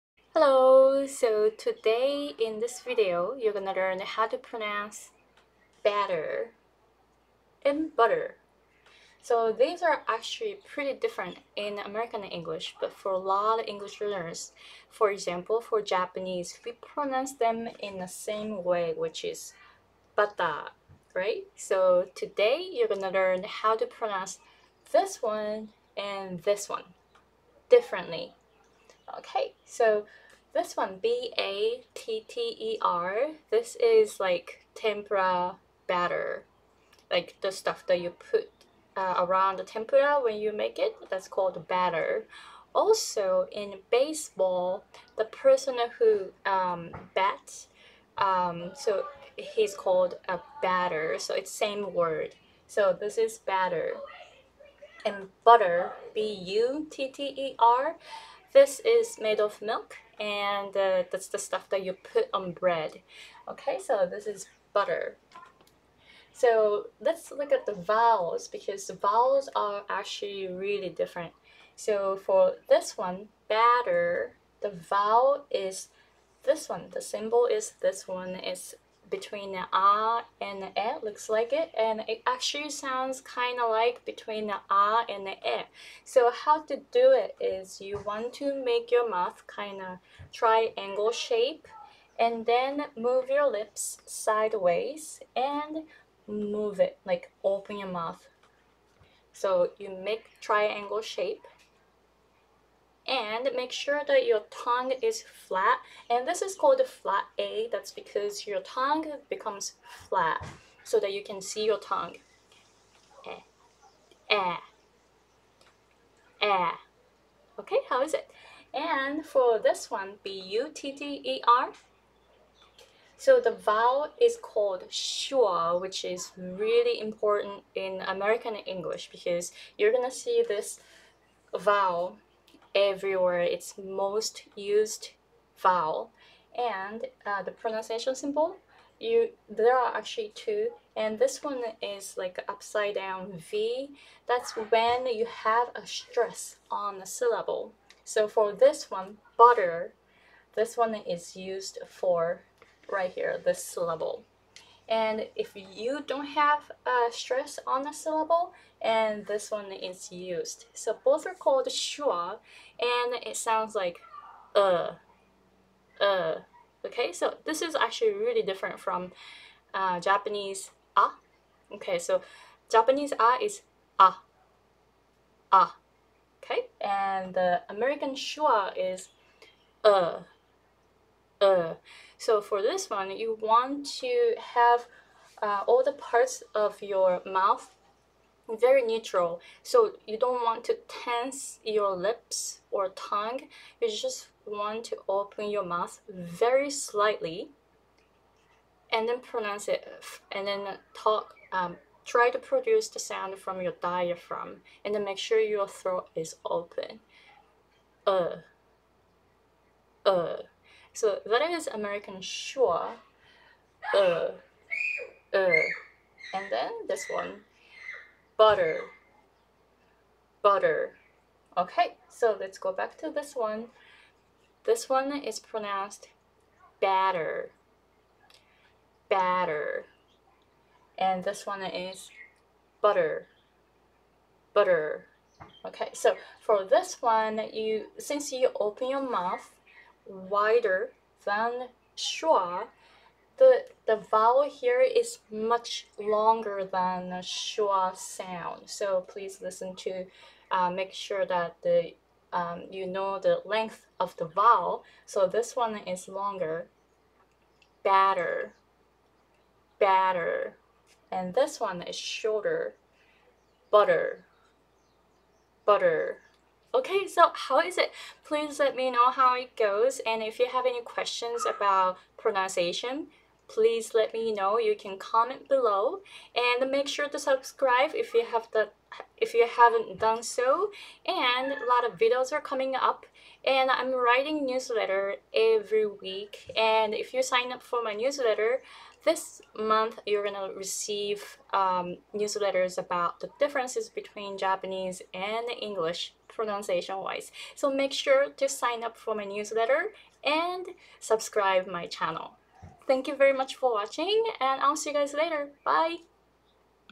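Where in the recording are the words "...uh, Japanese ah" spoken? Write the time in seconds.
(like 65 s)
169 s.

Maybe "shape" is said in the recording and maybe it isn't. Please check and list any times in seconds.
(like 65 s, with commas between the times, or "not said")
91 s, 101 s.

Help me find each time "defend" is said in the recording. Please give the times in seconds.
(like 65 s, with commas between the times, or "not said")
not said.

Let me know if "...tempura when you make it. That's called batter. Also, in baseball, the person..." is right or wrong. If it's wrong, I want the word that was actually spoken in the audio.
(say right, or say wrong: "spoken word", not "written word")
right.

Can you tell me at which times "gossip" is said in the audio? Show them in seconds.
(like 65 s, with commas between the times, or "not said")
not said.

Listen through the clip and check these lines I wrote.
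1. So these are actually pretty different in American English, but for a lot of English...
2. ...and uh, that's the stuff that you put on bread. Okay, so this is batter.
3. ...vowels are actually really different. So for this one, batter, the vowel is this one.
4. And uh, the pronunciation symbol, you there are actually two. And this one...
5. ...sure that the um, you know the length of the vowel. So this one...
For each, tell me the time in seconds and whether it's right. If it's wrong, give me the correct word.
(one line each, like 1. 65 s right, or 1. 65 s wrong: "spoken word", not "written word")
1. 9 s right
2. 60 s wrong: "butter", not "batter"
3. 68 s right
4. 136 s right
5. 250 s right.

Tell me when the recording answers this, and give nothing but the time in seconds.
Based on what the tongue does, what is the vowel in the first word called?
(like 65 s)
106 s.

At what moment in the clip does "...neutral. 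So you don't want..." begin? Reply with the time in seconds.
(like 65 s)
188 s.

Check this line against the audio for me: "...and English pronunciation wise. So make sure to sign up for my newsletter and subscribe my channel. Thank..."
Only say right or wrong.
right.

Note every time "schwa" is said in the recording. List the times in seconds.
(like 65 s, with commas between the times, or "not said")
124 s, 161 s, 178 s, 212 s, 241 s, 247 s.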